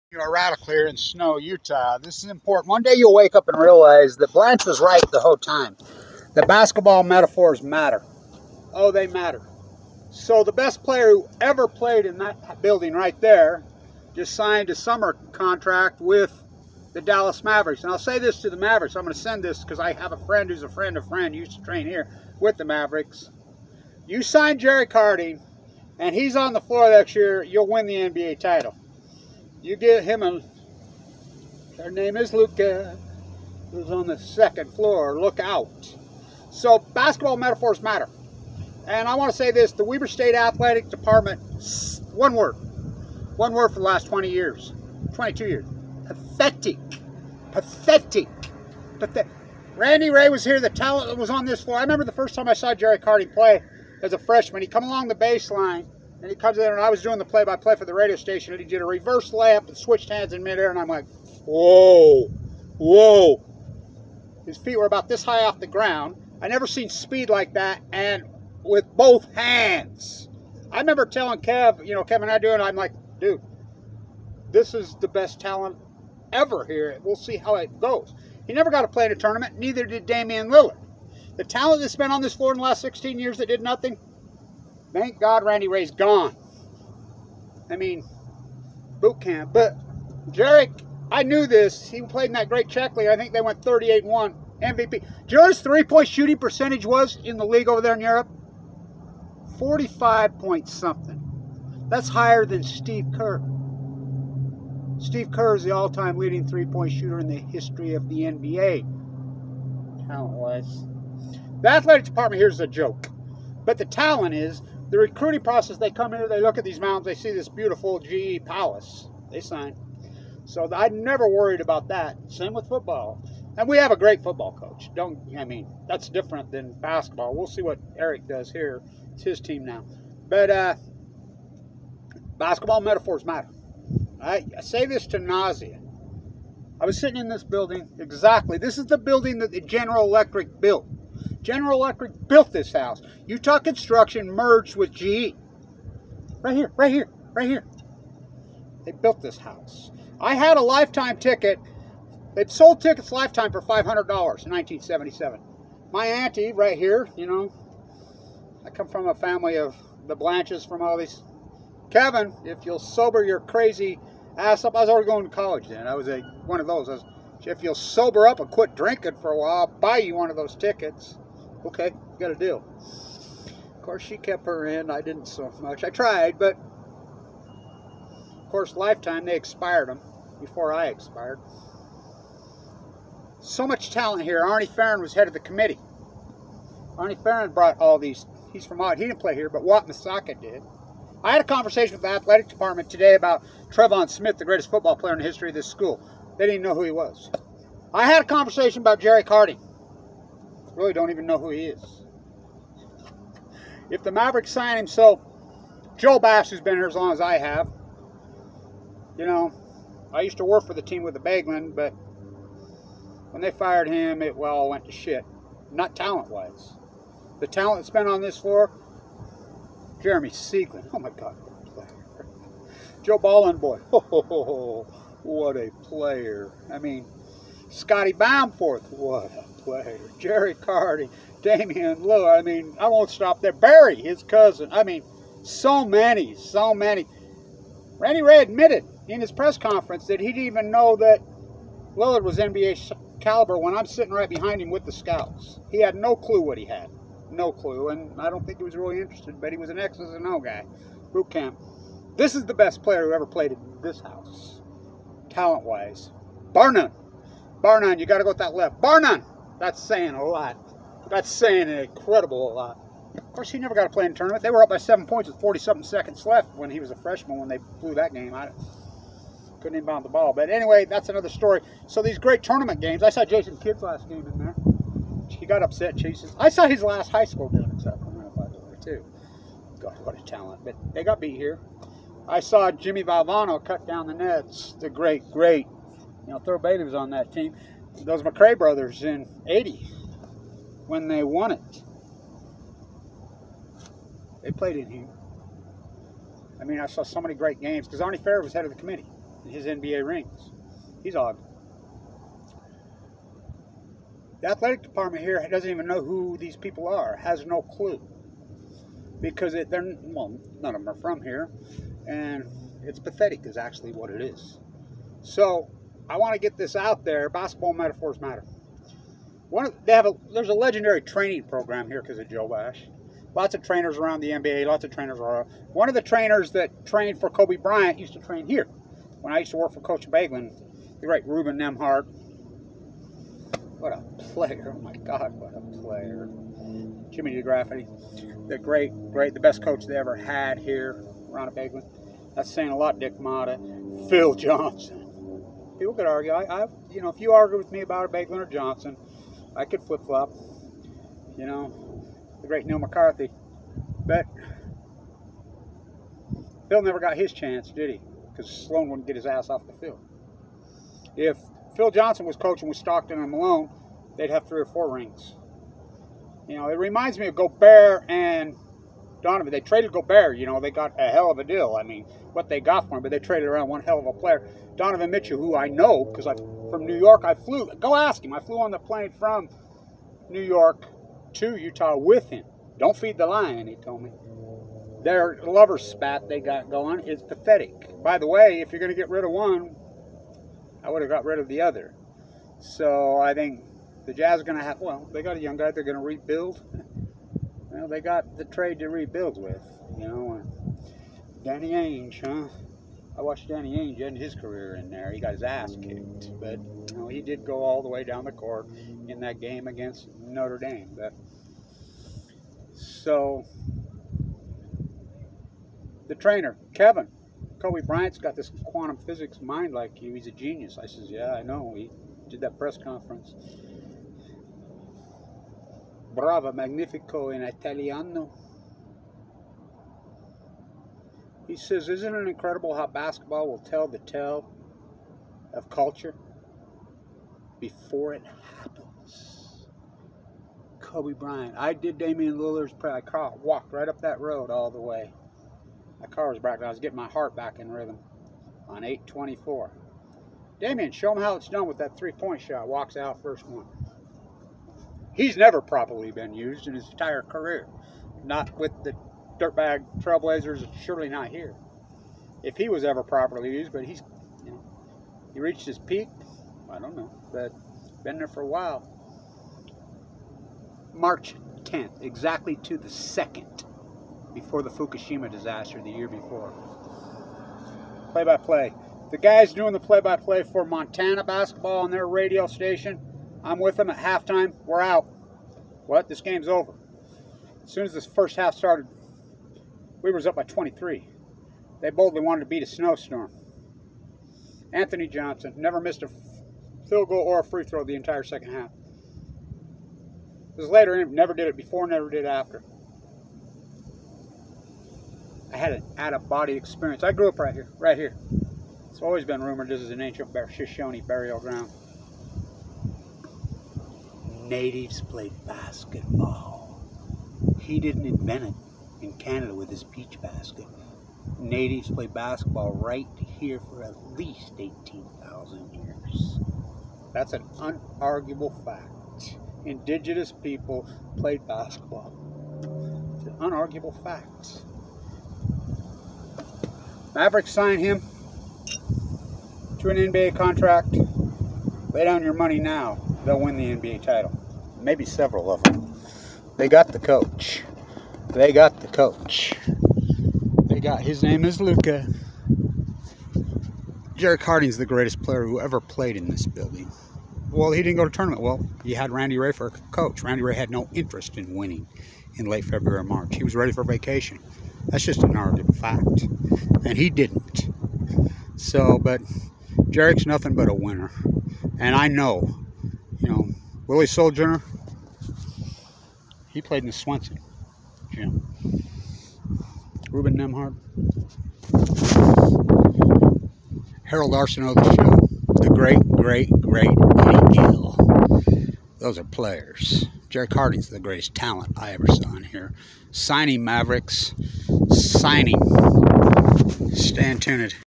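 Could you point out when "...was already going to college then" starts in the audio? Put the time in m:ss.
2:44.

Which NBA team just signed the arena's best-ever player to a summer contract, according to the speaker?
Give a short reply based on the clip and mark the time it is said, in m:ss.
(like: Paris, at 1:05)
Dallas Mavericks, at 0:16.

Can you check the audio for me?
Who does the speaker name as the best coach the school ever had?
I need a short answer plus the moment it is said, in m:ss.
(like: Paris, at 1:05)
Ron Abegglen, at 5:41.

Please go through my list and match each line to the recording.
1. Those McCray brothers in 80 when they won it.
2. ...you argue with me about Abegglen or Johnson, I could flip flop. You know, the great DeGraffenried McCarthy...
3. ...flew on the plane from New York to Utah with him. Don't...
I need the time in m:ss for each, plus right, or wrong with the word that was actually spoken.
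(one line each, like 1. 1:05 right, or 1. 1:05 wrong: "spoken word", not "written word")
1. 4:48 right
2. 5:47 wrong: "Neil", not "DeGraffenried"
3. 6:18 right.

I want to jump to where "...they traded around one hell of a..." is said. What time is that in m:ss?
6:13.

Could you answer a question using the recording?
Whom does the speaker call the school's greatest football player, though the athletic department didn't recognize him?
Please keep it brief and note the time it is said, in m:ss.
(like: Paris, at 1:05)
Trevon Smith, at 3:13.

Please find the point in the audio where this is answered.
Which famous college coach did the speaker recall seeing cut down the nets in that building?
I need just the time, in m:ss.
4:42.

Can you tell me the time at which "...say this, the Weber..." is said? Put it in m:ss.
0:39.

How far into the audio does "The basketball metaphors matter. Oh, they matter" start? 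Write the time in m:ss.
0:06.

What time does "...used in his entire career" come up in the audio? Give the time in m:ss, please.
7:36.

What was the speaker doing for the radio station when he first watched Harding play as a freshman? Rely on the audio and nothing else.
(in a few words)
play-by-play.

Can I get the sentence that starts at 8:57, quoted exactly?
Mavericks signed him to an NBA contract.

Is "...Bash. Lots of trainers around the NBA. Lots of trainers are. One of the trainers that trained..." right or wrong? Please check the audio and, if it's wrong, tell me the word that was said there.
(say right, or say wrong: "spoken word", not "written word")
right.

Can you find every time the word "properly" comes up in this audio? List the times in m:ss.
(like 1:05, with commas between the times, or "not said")
7:35, 7:43.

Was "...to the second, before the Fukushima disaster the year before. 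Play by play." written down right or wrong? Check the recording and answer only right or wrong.
right.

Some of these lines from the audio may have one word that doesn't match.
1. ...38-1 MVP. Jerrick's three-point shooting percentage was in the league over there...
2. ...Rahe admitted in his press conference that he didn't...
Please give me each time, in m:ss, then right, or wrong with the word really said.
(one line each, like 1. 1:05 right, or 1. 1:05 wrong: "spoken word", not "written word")
1. 1:33 right
2. 3:58 right.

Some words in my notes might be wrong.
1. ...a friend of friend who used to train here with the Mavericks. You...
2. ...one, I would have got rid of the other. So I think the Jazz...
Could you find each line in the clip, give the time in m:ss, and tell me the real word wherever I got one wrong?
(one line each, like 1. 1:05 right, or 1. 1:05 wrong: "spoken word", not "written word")
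1. 0:20 right
2. 6:29 right.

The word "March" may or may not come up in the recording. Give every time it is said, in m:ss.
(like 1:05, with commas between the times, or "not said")
7:50, 9:23.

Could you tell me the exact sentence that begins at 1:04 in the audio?
His feet were about this high off the ground.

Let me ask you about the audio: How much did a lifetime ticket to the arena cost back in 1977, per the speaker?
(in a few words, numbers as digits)
$500.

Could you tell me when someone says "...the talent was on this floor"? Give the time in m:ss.
0:50.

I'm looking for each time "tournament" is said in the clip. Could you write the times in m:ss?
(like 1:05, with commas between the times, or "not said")
1:19, 4:24, 4:32, 9:18.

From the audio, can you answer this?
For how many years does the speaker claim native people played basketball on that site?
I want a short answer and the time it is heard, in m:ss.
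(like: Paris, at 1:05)
18,000, at 8:44.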